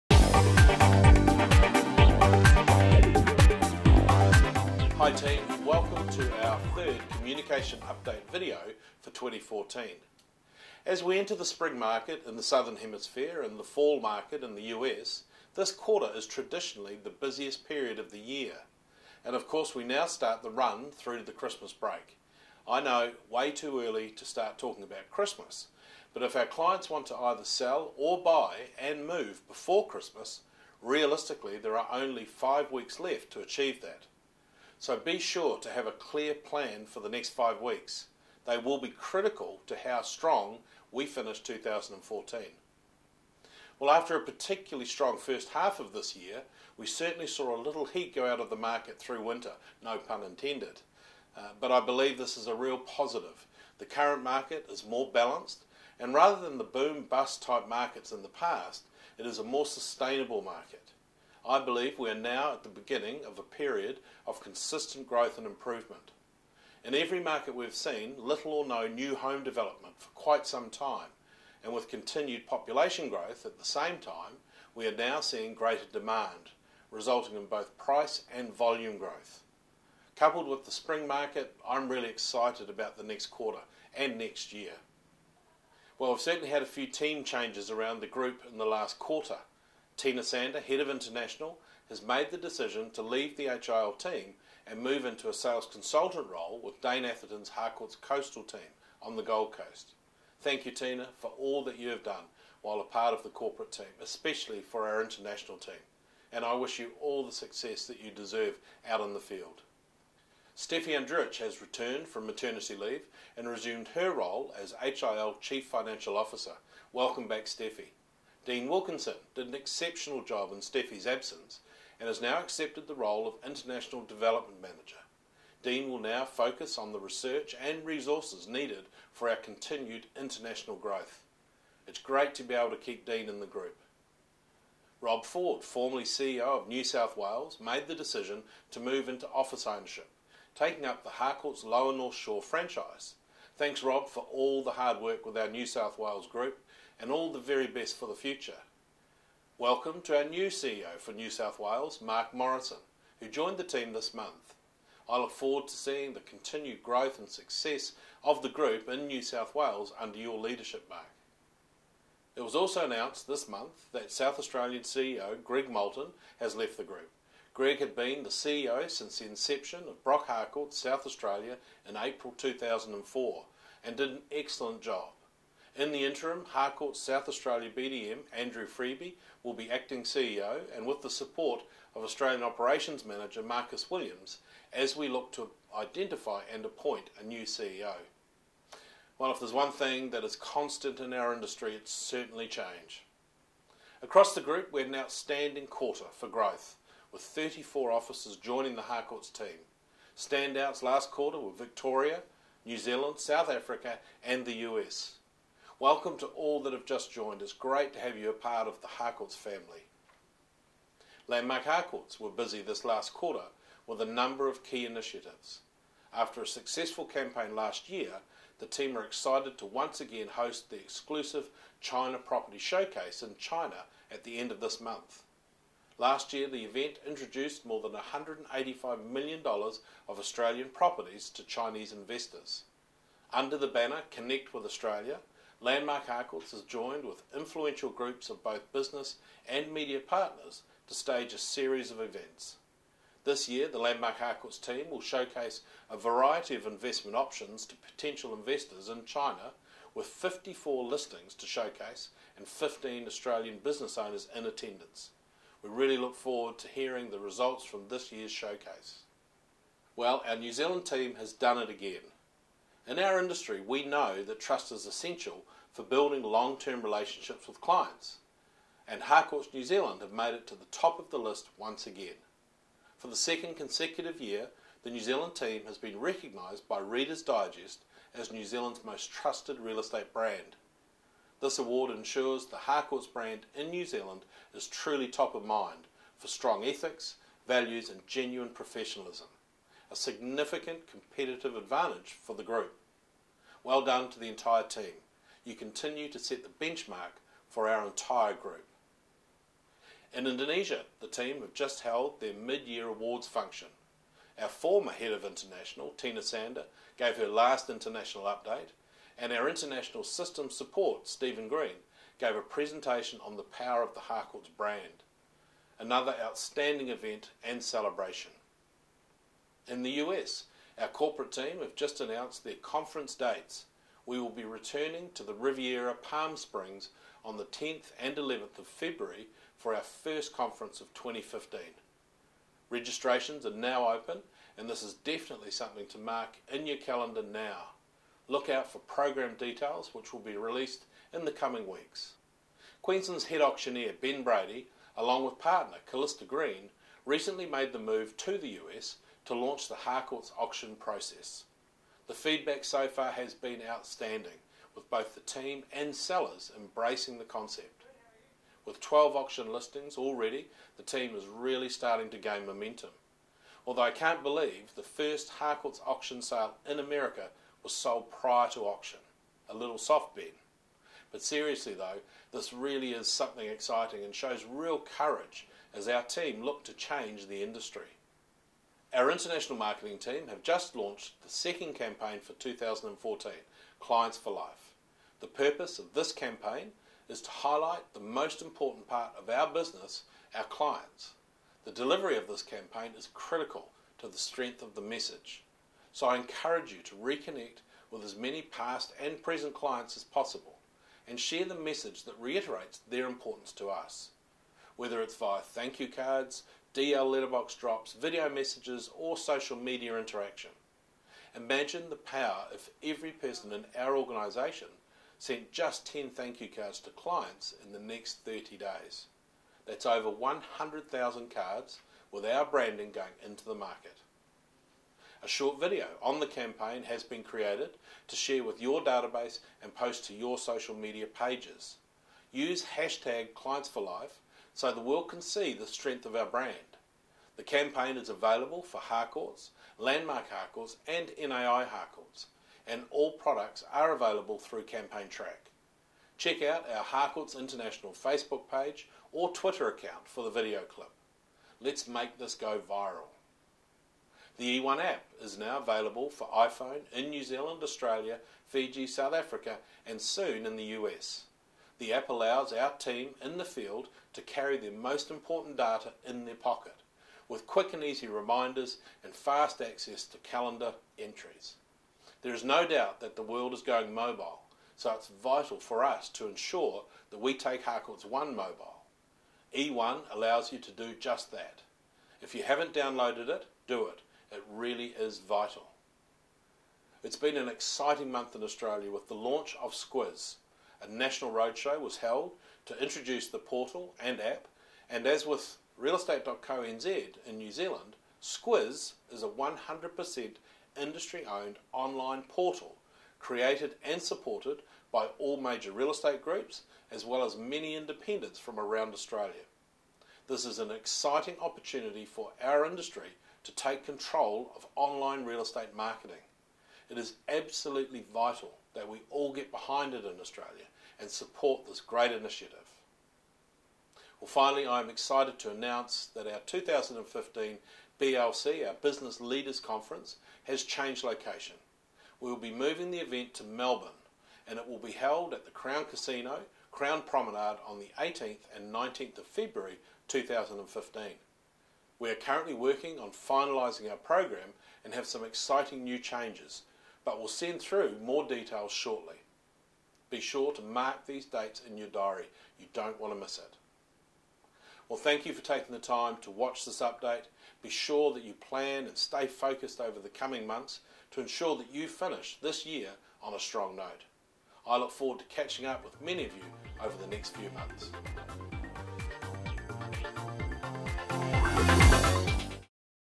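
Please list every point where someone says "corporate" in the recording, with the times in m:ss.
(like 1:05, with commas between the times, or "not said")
1:43, 5:20.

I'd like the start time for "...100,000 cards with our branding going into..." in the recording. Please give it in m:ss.
7:00.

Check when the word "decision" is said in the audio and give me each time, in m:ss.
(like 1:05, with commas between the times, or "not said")
1:32, 2:17.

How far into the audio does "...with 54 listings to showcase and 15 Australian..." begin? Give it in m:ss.
4:09.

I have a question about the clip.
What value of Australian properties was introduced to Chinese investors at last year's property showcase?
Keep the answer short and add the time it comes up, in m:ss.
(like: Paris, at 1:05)
$185 million, at 3:47.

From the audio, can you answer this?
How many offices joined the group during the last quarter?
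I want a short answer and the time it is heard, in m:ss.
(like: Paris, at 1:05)
34, at 3:17.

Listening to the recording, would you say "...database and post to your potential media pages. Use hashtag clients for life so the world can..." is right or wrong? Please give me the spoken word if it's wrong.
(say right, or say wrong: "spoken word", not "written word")
wrong: "social", not "potential".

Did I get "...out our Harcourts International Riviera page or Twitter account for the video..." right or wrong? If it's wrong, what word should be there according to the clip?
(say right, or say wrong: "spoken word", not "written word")
wrong: "Facebook", not "Riviera".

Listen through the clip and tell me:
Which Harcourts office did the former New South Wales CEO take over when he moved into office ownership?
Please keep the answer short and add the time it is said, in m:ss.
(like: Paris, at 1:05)
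Lower North Shore, at 2:21.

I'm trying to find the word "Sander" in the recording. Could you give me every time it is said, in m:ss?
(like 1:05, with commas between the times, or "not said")
1:30, 5:06.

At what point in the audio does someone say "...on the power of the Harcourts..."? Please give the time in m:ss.
5:13.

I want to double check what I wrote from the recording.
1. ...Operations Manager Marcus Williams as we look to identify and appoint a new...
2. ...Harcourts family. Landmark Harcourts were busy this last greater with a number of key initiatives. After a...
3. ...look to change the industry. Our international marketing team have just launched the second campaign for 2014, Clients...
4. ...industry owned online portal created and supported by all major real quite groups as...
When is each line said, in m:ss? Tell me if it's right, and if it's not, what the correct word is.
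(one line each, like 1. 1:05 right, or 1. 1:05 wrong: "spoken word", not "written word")
1. 3:02 right
2. 3:28 wrong: "quarter", not "greater"
3. 6:16 right
4. 8:20 wrong: "estate", not "quite".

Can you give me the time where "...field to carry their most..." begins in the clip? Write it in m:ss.
7:43.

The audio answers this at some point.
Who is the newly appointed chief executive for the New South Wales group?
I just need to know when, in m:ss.
2:32.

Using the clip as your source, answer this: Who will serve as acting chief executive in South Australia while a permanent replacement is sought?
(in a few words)
Andrew Freeby.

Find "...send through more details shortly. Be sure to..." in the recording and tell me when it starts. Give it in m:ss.
9:07.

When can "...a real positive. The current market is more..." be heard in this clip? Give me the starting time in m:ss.
0:52.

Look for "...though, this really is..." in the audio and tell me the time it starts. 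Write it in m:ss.
6:11.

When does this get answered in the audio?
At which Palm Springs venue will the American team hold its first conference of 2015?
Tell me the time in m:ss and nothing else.
5:25.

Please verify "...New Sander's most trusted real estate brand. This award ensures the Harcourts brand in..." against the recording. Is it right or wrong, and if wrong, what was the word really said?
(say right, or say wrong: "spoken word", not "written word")
wrong: "Zealand", not "Sander".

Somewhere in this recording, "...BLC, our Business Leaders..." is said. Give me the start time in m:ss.
8:47.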